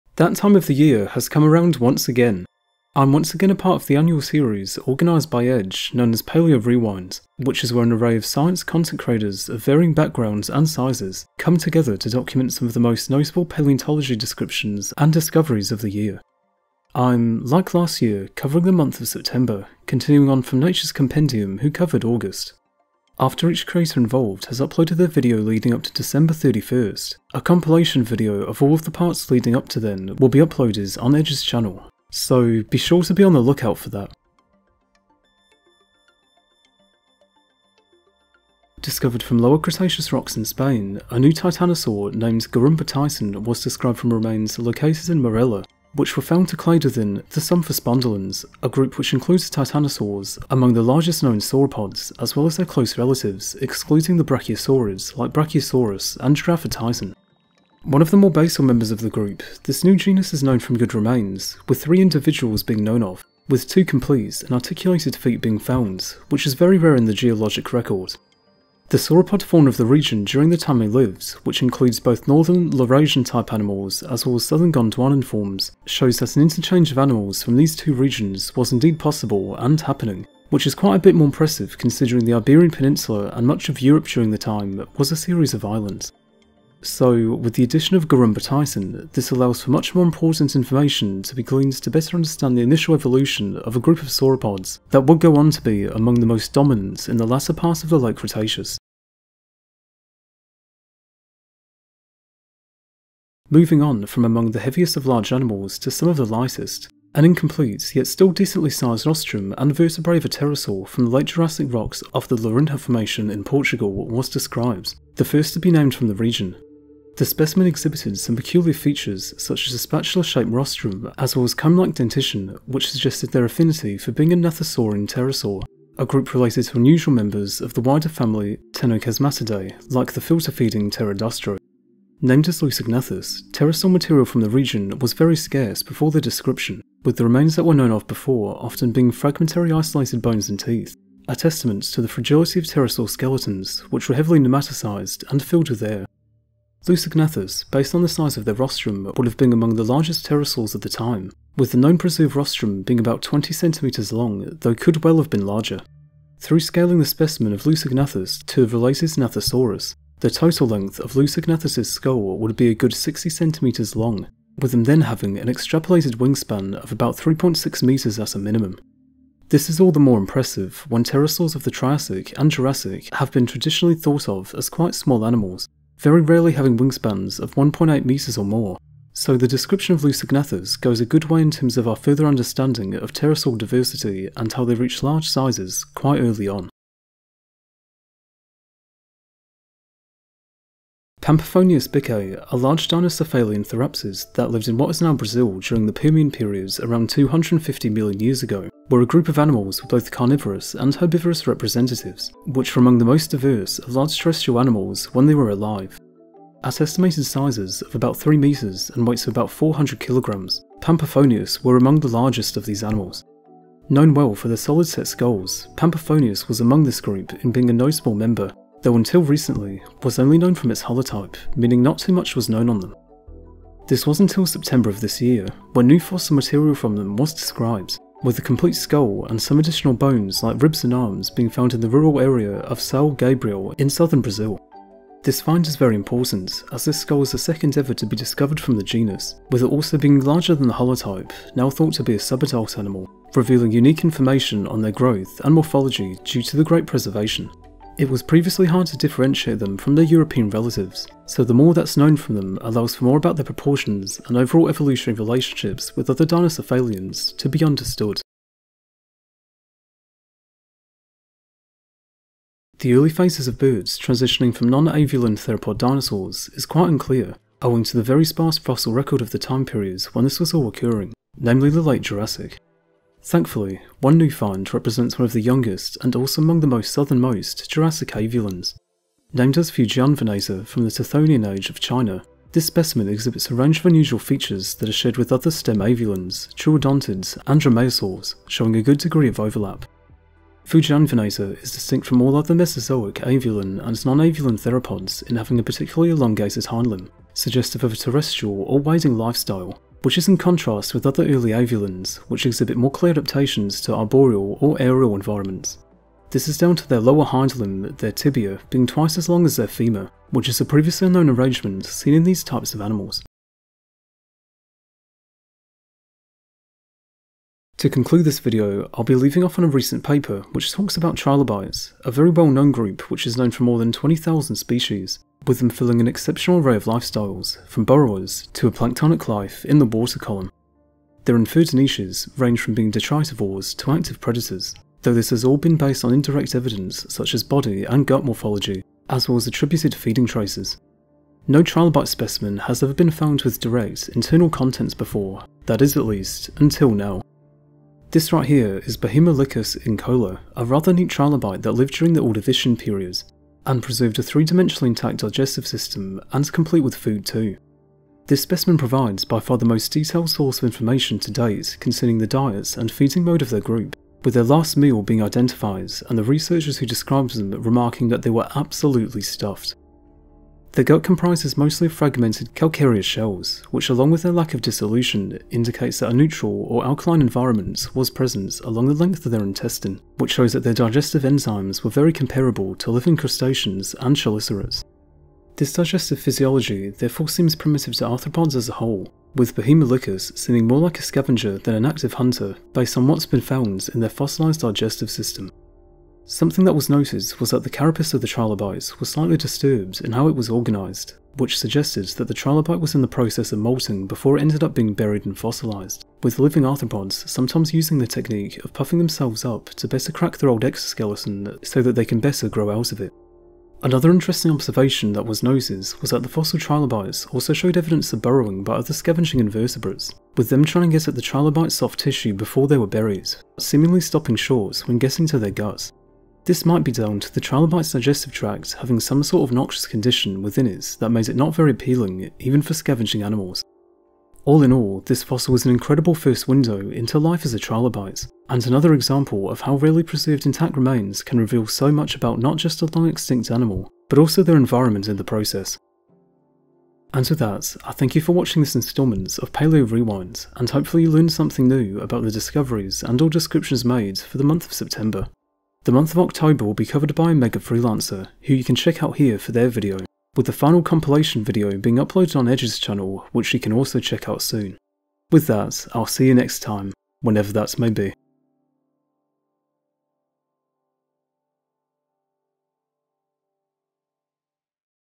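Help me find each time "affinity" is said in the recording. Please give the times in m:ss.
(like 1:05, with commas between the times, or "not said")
2:03.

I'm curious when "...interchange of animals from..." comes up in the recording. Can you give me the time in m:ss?
1:16.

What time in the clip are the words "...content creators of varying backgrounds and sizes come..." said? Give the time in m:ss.
0:08.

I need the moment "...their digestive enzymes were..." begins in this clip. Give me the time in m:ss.
6:20.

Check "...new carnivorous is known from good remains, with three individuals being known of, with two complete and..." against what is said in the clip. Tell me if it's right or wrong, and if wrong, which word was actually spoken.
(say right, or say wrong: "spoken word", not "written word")
wrong: "genus", not "carnivorous".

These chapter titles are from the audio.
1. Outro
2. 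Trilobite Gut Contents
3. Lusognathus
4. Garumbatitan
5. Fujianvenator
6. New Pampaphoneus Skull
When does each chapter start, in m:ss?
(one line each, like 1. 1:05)
1. 7:27
2. 5:15
3. 1:40
4. 0:35
5. 4:19
6. 3:08.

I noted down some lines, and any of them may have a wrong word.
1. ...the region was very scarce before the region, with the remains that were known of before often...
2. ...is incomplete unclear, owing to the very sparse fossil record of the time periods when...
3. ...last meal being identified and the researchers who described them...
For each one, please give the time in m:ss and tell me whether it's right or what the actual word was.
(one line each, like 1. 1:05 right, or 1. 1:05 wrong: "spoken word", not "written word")
1. 2:14 wrong: "description", not "region"
2. 4:26 wrong: "quite", not "incomplete"
3. 6:04 right.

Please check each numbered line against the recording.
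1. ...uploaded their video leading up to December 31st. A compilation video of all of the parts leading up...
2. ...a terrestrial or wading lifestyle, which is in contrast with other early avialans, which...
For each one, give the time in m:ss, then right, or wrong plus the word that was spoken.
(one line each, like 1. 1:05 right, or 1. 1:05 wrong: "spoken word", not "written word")
1. 0:24 right
2. 4:57 right.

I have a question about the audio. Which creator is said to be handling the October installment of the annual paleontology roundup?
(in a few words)
Mega Freelancer.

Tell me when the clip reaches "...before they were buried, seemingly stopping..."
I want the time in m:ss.
7:02.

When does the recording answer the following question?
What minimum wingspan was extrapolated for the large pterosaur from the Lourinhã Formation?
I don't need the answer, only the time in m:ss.
2:47.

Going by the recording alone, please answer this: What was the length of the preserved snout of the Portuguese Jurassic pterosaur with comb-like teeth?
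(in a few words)
20 centimeters.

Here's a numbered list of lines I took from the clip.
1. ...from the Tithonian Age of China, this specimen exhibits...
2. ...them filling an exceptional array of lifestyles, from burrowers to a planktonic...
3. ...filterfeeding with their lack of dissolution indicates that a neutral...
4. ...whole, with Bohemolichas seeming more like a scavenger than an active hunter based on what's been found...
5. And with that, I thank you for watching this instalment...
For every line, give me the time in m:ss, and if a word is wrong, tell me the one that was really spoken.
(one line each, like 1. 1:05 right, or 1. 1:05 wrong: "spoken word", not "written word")
1. 4:40 right
2. 5:25 right
3. 6:13 wrong: "along", not "filterfeeding"
4. 6:28 right
5. 7:27 right.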